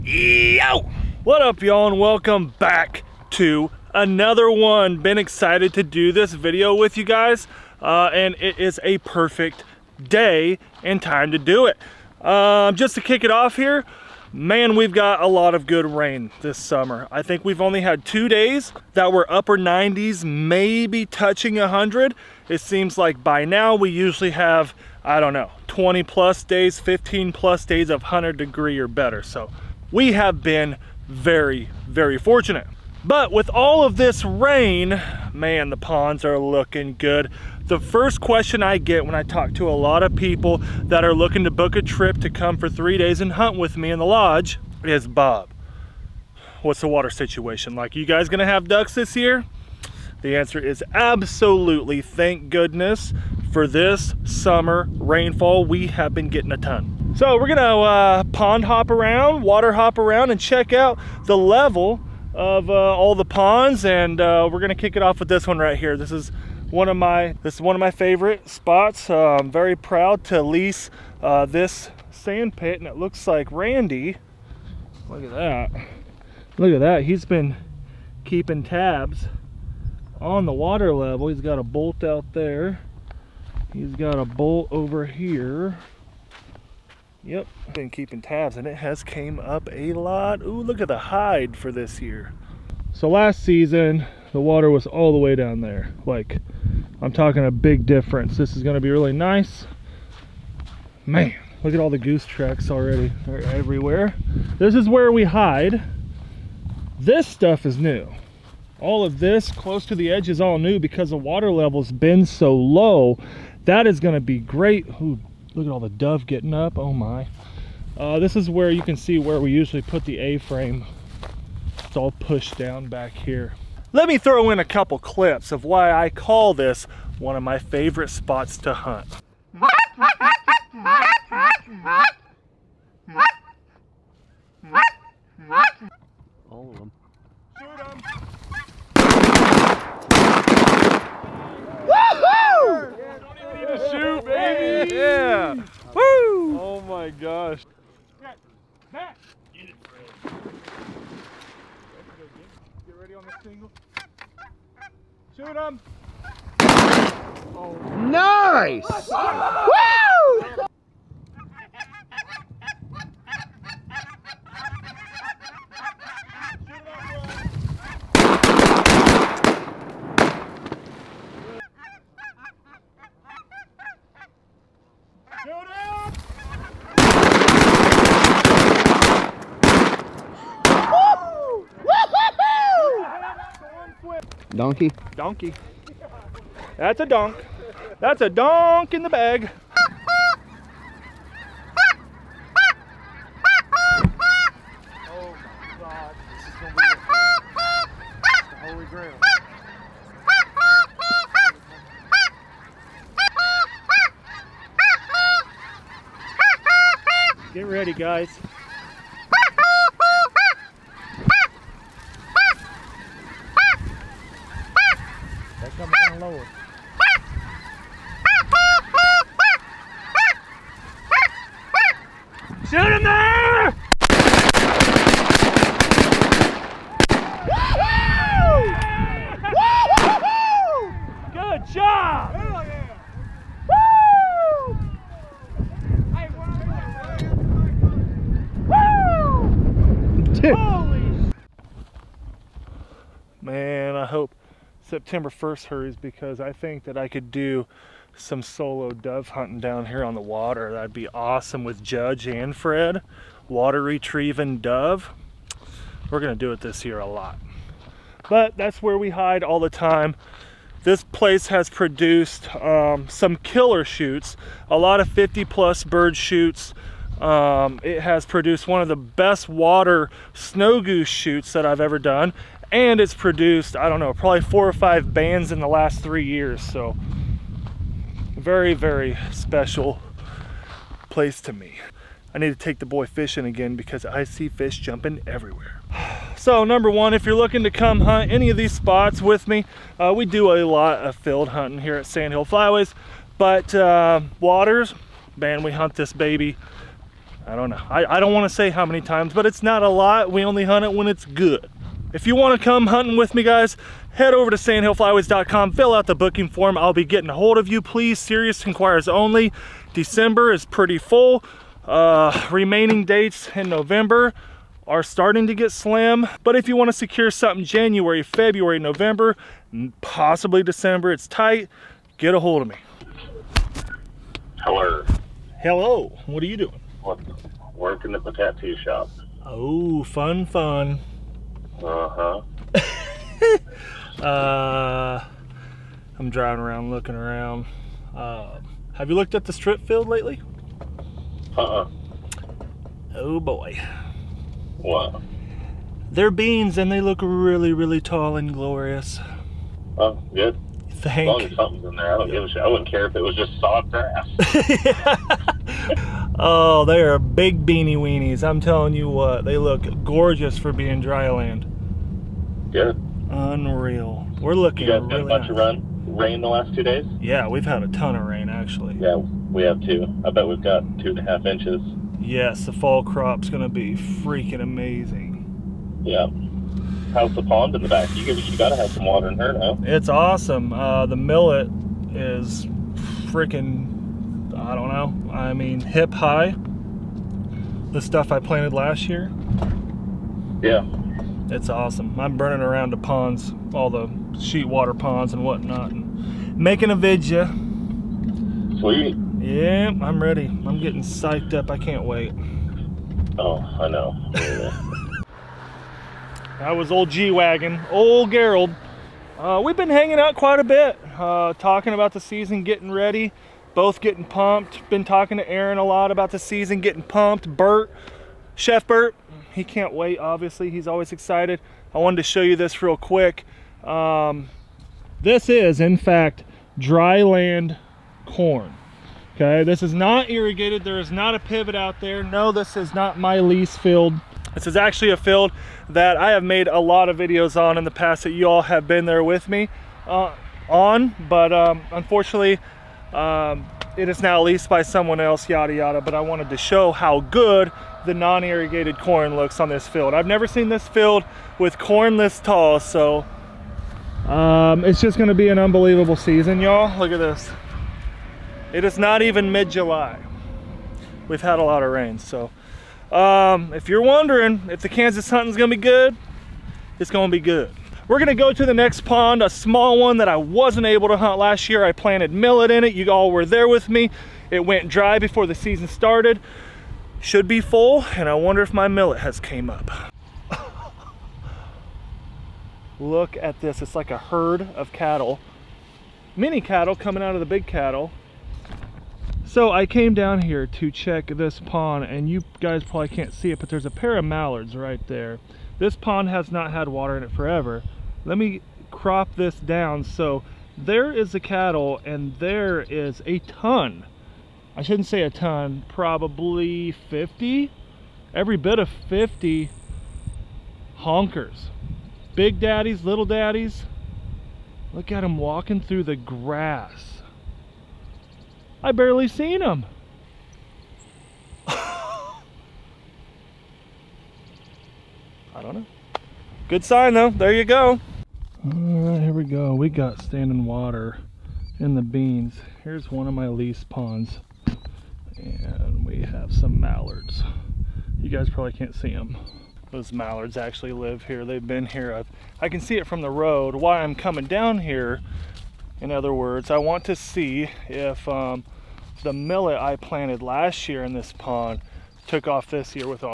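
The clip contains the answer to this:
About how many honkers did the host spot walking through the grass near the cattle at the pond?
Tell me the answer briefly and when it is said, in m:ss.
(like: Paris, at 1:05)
50, at 8:28.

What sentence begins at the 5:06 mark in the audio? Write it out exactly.
I'll be getting a hold of you, please.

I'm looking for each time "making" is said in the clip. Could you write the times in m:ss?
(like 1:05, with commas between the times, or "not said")
6:36.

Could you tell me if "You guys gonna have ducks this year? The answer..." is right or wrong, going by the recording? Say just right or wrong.
right.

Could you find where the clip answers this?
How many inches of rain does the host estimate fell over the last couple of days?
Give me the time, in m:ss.
6:10.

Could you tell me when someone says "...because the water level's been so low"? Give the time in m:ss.
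1:50.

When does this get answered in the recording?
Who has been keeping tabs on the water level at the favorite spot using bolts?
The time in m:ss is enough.
1:13.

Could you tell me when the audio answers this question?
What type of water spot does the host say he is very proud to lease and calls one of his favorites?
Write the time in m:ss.
1:12.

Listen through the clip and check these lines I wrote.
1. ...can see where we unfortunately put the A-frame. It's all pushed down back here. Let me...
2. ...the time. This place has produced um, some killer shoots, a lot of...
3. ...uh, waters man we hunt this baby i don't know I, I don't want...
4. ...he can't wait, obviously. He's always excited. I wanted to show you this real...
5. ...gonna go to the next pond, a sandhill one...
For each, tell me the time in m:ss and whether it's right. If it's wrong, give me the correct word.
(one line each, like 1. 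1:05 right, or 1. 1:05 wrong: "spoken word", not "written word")
1. 1:58 wrong: "usually", not "unfortunately"
2. 4:19 right
3. 4:53 right
4. 6:59 right
5. 7:48 wrong: "small", not "sandhill".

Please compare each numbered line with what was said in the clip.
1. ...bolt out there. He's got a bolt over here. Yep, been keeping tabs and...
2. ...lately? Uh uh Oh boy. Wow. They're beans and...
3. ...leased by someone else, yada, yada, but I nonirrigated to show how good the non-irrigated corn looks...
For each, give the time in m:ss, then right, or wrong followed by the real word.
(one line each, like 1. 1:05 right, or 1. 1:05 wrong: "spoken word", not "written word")
1. 1:21 right
2. 5:40 right
3. 7:24 wrong: "wanted", not "nonirrigated".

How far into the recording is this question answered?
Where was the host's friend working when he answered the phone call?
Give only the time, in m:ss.
5:28.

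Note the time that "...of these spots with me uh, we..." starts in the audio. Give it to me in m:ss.
4:48.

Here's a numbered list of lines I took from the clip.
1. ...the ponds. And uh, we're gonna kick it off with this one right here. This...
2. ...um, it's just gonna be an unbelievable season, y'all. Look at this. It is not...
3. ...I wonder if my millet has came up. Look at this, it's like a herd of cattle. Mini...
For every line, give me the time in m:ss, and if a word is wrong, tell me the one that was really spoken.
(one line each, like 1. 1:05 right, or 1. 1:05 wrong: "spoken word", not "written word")
1. 1:03 right
2. 7:34 right
3. 7:58 right.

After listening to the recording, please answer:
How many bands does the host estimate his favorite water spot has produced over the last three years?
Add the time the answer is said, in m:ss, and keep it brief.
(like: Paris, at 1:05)
4 or 5, at 4:34.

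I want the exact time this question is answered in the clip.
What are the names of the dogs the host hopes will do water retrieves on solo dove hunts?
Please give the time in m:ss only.
4:11.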